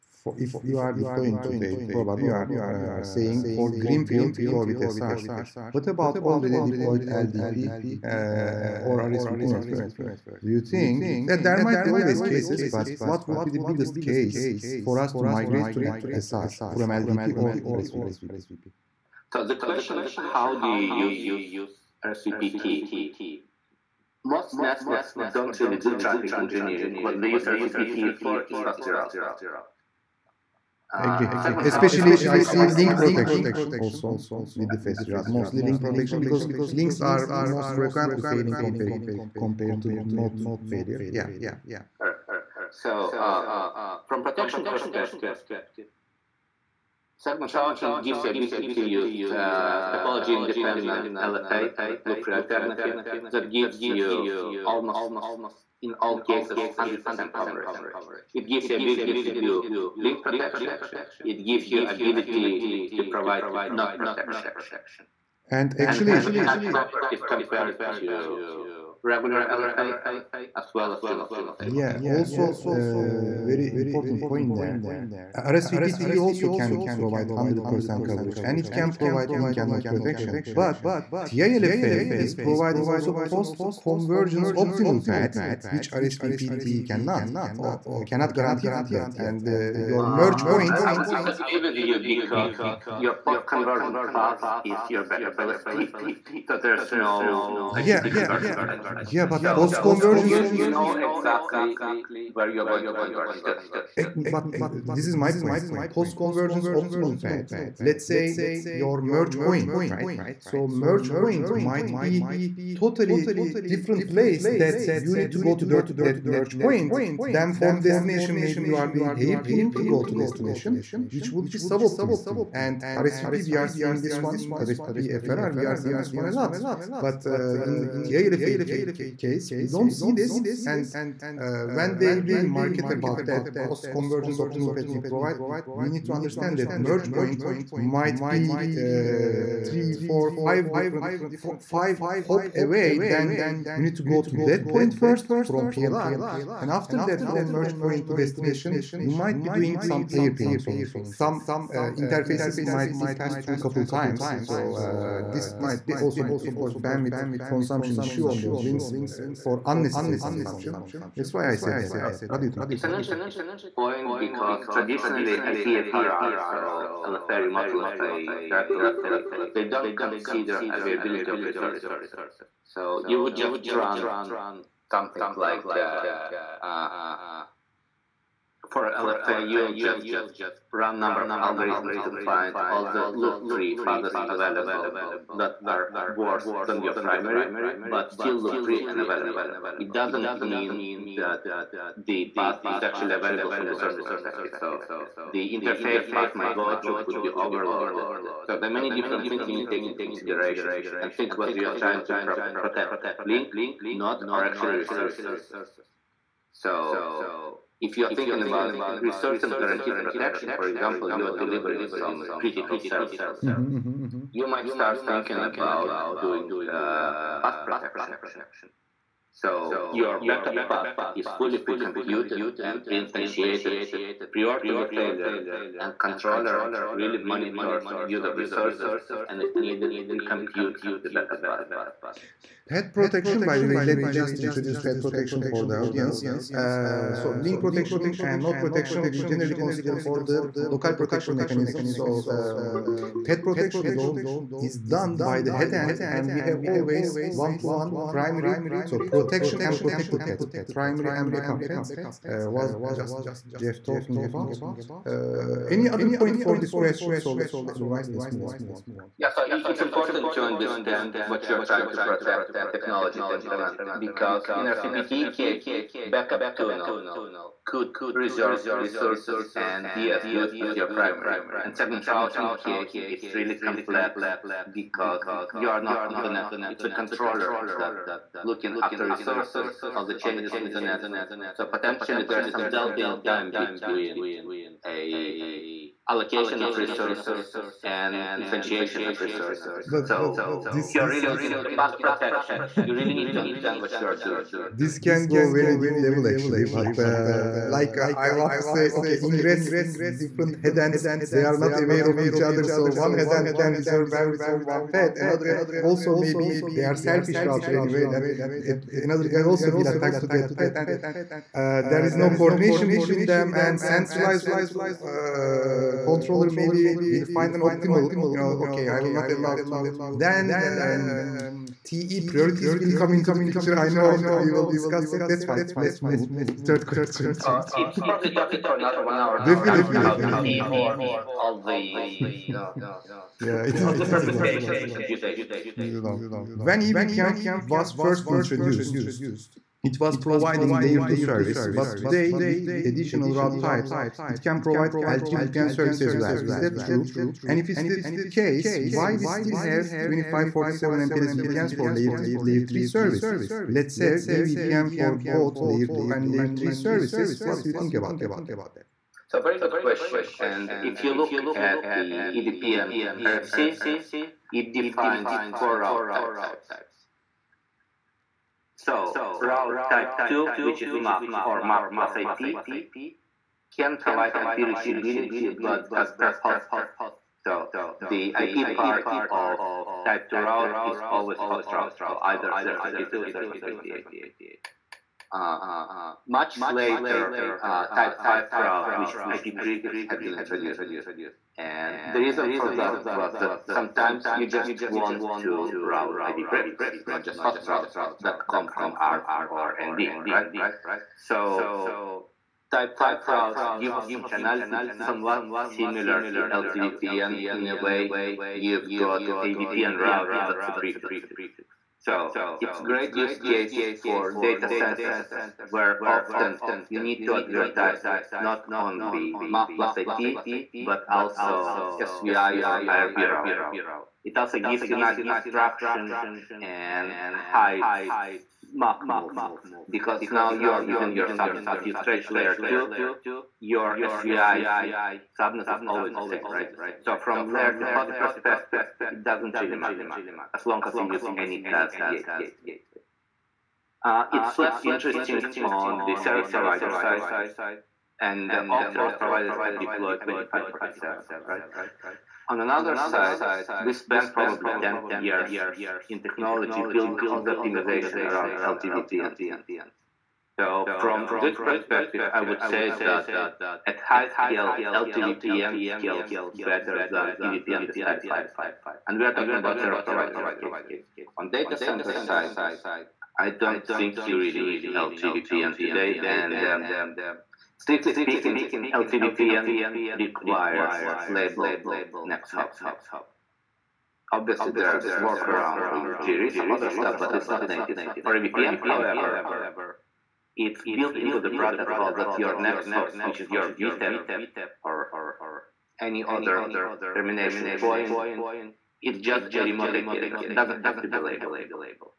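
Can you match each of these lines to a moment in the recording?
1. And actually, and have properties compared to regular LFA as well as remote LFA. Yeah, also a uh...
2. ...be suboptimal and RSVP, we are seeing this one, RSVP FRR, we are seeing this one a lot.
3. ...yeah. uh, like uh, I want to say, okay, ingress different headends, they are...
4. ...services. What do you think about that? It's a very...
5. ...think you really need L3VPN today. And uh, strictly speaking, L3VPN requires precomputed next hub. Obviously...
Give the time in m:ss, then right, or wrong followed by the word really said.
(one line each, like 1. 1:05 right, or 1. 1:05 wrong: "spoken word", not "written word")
1. 1:05 right
2. 2:01 right
3. 4:56 right
4. 5:56 right
5. 7:53 wrong: "labeled", not "precomputed".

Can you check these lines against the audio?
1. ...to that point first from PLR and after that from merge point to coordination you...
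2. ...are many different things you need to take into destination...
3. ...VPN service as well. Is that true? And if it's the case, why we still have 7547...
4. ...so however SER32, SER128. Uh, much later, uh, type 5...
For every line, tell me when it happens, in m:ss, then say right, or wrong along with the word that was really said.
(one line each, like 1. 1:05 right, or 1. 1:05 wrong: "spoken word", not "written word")
1. 2:24 wrong: "destination", not "coordination"
2. 3:18 wrong: "consideration", not "destination"
3. 5:45 wrong: "2547", not "7547"
4. 6:22 wrong: "either", not "however".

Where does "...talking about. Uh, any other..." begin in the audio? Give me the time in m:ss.
4:13.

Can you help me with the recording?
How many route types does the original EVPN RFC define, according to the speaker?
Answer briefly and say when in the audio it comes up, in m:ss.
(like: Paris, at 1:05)
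4, at 6:05.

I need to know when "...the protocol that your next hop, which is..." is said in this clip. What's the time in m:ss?
8:11.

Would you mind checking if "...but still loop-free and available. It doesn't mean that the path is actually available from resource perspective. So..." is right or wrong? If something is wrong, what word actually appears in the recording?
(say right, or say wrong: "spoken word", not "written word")
right.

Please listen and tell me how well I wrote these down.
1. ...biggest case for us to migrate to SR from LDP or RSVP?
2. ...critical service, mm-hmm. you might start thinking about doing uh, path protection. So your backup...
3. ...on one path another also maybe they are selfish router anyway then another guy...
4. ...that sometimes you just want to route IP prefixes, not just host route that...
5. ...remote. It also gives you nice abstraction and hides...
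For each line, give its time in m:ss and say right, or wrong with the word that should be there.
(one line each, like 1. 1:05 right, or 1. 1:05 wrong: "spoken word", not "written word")
1. 0:13 right
2. 3:32 right
3. 5:04 right
4. 6:33 right
5. 7:03 wrong: "route", not "remote".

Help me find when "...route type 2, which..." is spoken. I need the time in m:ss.
6:09.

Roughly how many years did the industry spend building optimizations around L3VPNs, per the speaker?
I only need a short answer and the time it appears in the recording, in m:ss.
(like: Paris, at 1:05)
10 years, at 7:34.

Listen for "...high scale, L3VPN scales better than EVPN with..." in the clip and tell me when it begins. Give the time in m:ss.
7:43.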